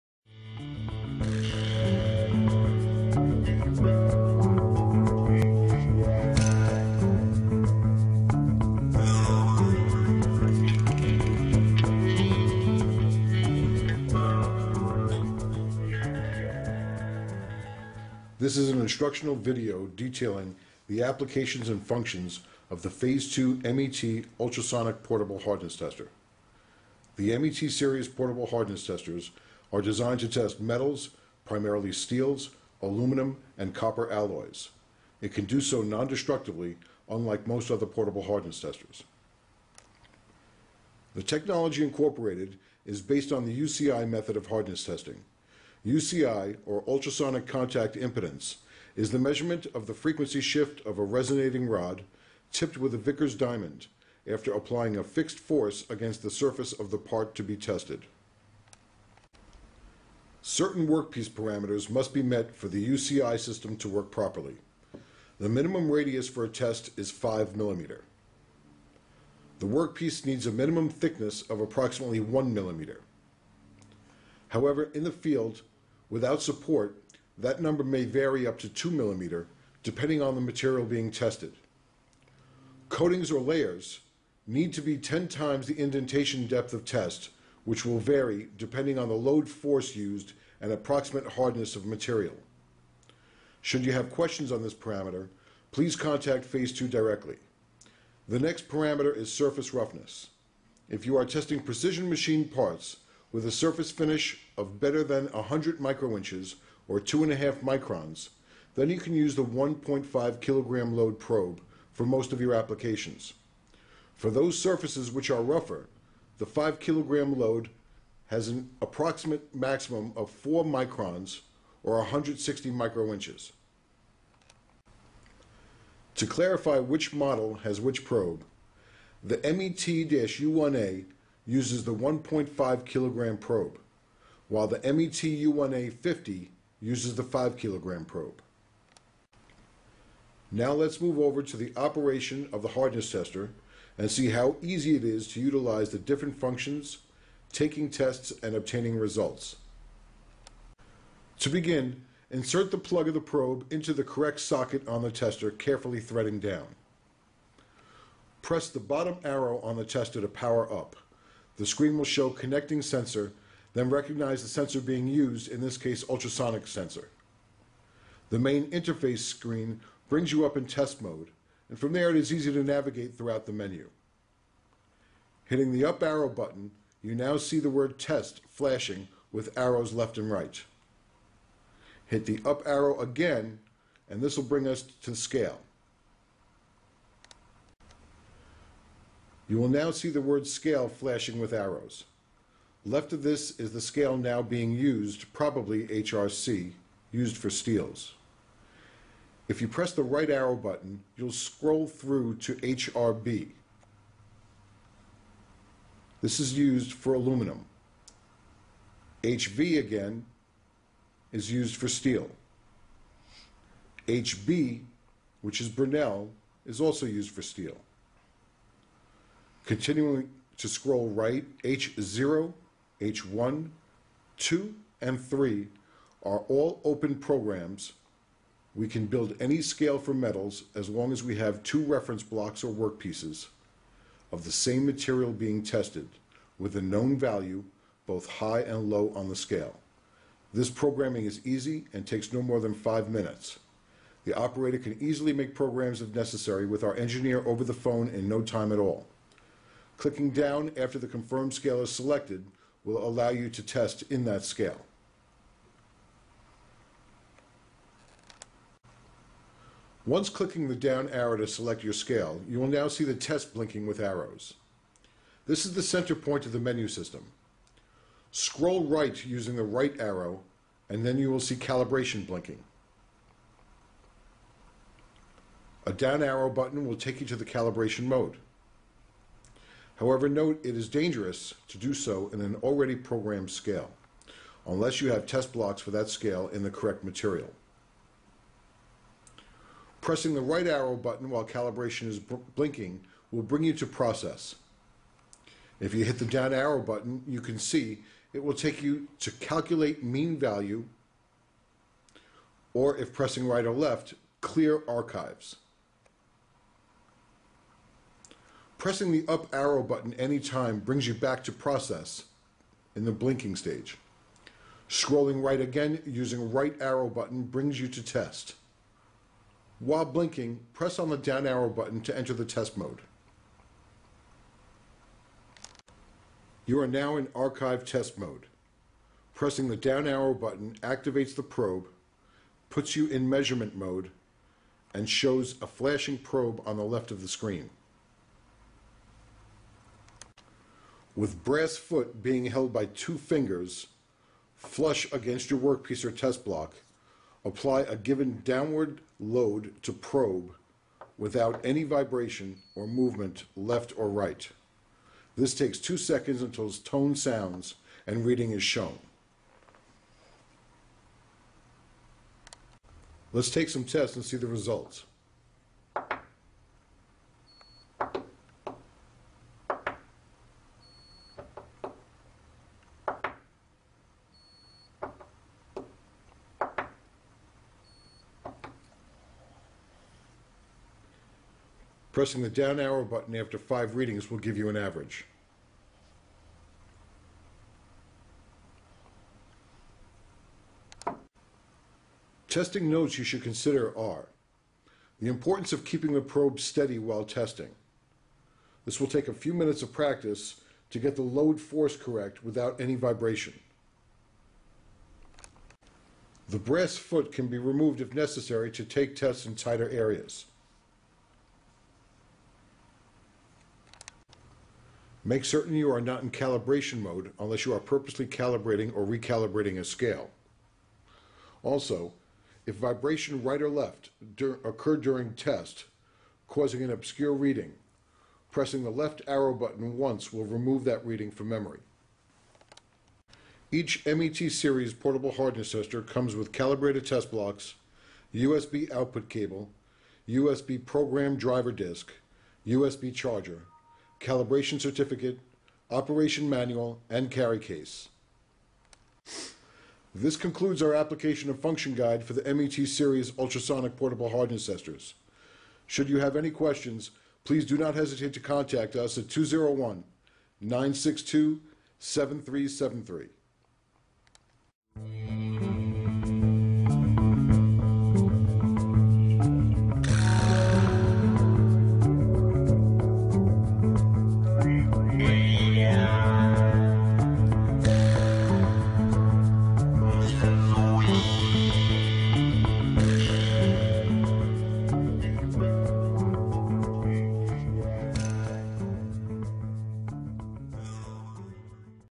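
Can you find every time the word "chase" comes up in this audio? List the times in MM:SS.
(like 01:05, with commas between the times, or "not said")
not said.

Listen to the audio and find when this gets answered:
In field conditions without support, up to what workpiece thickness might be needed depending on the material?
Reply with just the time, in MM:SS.
01:18.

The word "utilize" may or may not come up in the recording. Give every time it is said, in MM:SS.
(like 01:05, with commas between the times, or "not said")
02:25.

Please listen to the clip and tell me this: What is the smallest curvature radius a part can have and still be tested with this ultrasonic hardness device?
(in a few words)
5 millimeter.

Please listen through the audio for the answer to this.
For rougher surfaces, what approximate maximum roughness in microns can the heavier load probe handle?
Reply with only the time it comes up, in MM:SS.
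02:00.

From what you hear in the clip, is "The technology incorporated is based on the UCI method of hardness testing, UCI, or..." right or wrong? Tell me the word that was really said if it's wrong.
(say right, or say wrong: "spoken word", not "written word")
right.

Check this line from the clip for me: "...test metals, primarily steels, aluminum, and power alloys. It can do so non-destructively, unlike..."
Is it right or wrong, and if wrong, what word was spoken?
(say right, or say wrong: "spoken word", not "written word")
wrong: "copper", not "power".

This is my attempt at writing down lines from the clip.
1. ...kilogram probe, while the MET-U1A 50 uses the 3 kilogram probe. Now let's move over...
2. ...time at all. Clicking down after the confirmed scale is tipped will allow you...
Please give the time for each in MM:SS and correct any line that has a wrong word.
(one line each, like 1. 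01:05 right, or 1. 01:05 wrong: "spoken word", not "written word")
1. 02:12 wrong: "5", not "3"
2. 04:08 wrong: "selected", not "tipped".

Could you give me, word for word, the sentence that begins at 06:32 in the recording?
Testing notes you should consider are the importance of keeping the probe steady while testing.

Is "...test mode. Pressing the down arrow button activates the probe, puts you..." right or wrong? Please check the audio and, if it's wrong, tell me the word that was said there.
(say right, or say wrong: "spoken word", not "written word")
right.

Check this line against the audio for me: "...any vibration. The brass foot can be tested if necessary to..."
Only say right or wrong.
wrong.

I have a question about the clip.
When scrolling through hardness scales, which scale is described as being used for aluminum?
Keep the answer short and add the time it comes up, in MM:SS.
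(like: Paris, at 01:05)
HRB, at 03:22.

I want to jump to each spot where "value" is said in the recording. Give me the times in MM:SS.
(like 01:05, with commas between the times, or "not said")
03:57, 05:00.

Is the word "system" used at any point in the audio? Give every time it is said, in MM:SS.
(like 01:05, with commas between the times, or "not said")
01:03, 04:26.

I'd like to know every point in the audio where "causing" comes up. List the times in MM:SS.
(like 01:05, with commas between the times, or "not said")
07:06.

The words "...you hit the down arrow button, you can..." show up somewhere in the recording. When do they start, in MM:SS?
04:55.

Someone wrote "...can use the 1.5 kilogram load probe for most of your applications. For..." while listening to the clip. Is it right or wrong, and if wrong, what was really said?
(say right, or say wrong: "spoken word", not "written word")
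right.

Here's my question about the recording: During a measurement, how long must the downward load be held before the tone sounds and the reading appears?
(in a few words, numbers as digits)
2 seconds.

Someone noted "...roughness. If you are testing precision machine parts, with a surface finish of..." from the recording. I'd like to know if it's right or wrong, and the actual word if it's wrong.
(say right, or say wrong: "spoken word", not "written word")
right.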